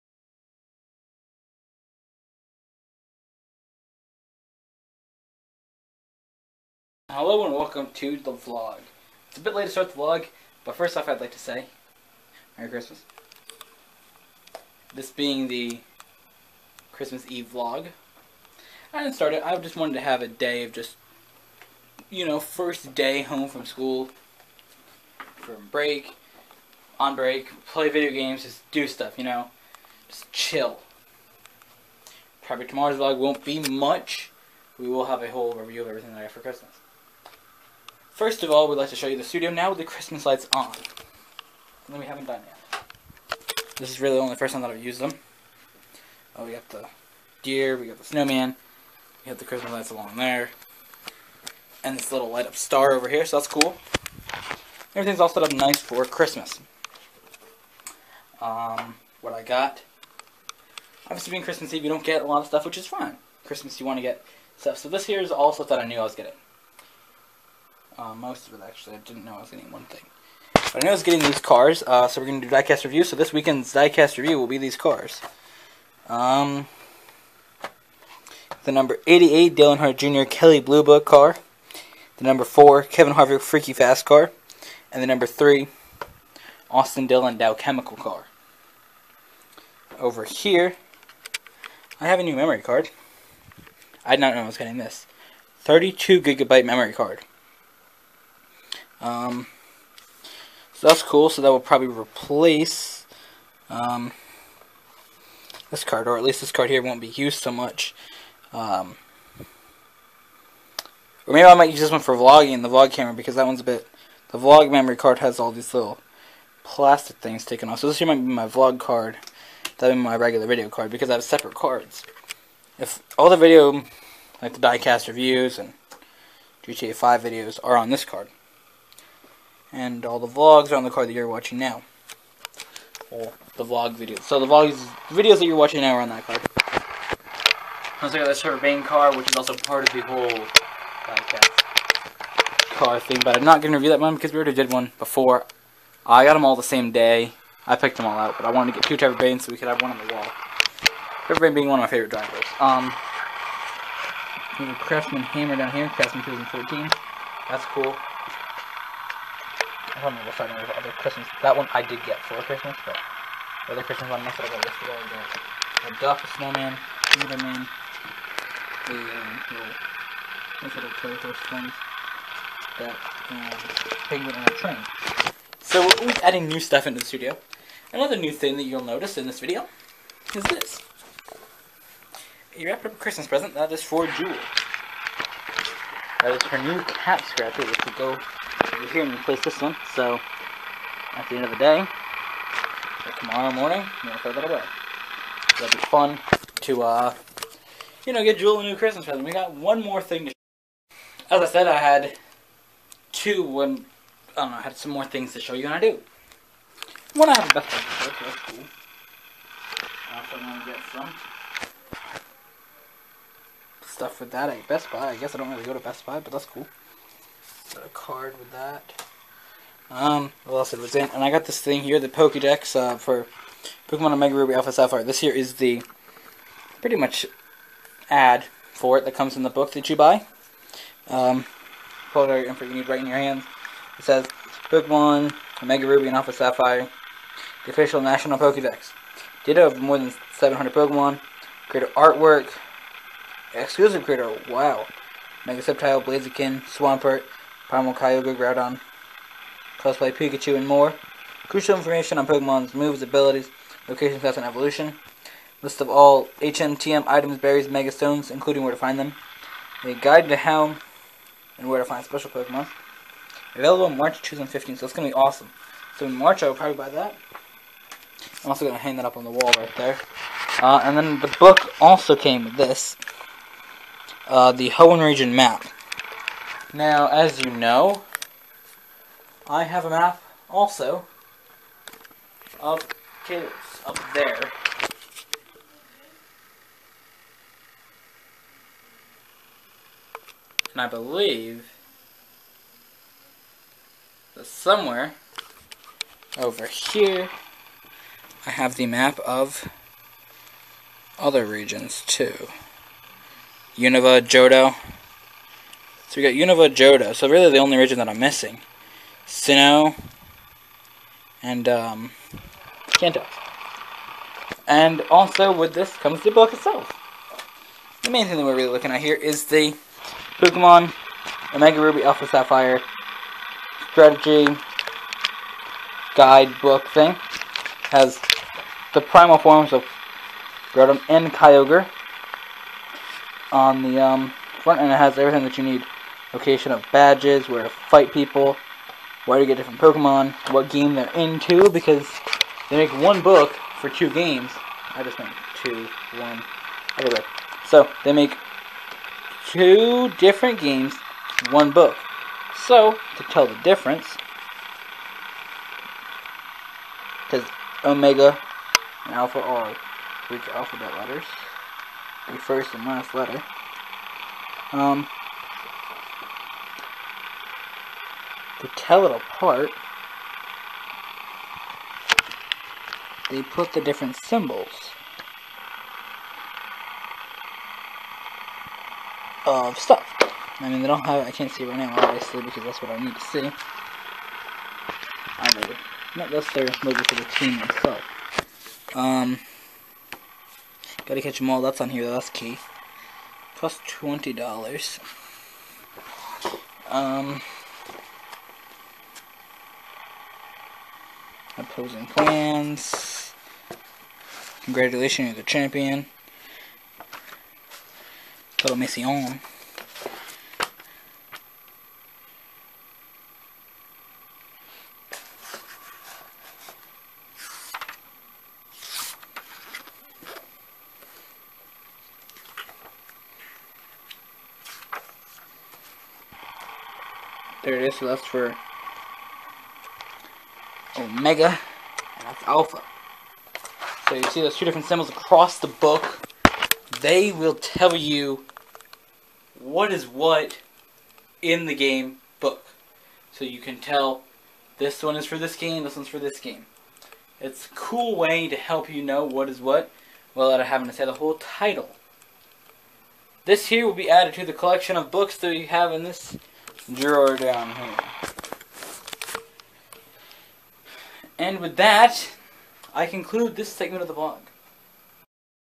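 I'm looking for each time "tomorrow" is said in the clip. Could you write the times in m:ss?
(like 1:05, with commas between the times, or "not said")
0:32, 3:13.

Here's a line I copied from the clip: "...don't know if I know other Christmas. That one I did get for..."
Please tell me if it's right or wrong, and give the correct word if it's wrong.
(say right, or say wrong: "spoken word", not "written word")
right.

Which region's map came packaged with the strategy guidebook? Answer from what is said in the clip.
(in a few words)
Hoenn.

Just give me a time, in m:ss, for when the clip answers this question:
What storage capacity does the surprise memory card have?
1:35.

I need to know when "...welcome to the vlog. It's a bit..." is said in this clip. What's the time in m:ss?
0:07.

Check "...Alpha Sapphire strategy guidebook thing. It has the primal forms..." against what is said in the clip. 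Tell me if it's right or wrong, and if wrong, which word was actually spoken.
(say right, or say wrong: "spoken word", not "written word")
right.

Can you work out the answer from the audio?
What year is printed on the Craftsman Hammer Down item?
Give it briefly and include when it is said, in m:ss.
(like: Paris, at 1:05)
2014, at 2:36.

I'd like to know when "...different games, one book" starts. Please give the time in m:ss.
5:50.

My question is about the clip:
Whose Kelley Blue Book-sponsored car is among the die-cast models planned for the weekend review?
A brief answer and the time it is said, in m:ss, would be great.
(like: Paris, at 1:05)
Dale Earnhardt Jr., at 1:19.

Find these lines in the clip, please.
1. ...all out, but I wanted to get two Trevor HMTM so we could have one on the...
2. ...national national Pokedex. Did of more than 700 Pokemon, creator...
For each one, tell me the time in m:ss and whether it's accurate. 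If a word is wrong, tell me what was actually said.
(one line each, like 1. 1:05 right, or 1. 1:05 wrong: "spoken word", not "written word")
1. 2:28 wrong: "Bayne", not "HMTM"
2. 3:57 wrong: "official", not "national".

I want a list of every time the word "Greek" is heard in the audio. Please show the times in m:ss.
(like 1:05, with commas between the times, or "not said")
6:00.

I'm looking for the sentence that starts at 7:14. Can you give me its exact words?
So you see those two different symbols across the book.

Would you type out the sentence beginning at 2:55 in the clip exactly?
So we're always adding new stuff into the studio.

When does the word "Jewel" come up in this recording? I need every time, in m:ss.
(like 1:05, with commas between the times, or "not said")
3:04, 3:18.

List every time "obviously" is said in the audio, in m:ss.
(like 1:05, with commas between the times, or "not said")
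1:01, 6:21.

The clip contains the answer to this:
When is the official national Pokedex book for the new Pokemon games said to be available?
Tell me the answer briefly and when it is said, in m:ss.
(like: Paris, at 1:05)
March 2015, at 4:23.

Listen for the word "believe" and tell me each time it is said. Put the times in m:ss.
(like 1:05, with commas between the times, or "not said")
4:50.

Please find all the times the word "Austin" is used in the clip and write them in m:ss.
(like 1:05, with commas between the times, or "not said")
1:26.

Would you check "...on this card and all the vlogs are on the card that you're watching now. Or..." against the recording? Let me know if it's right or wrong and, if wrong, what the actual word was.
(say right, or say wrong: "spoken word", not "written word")
right.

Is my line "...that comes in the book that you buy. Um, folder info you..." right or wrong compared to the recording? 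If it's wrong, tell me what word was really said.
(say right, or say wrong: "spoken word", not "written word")
right.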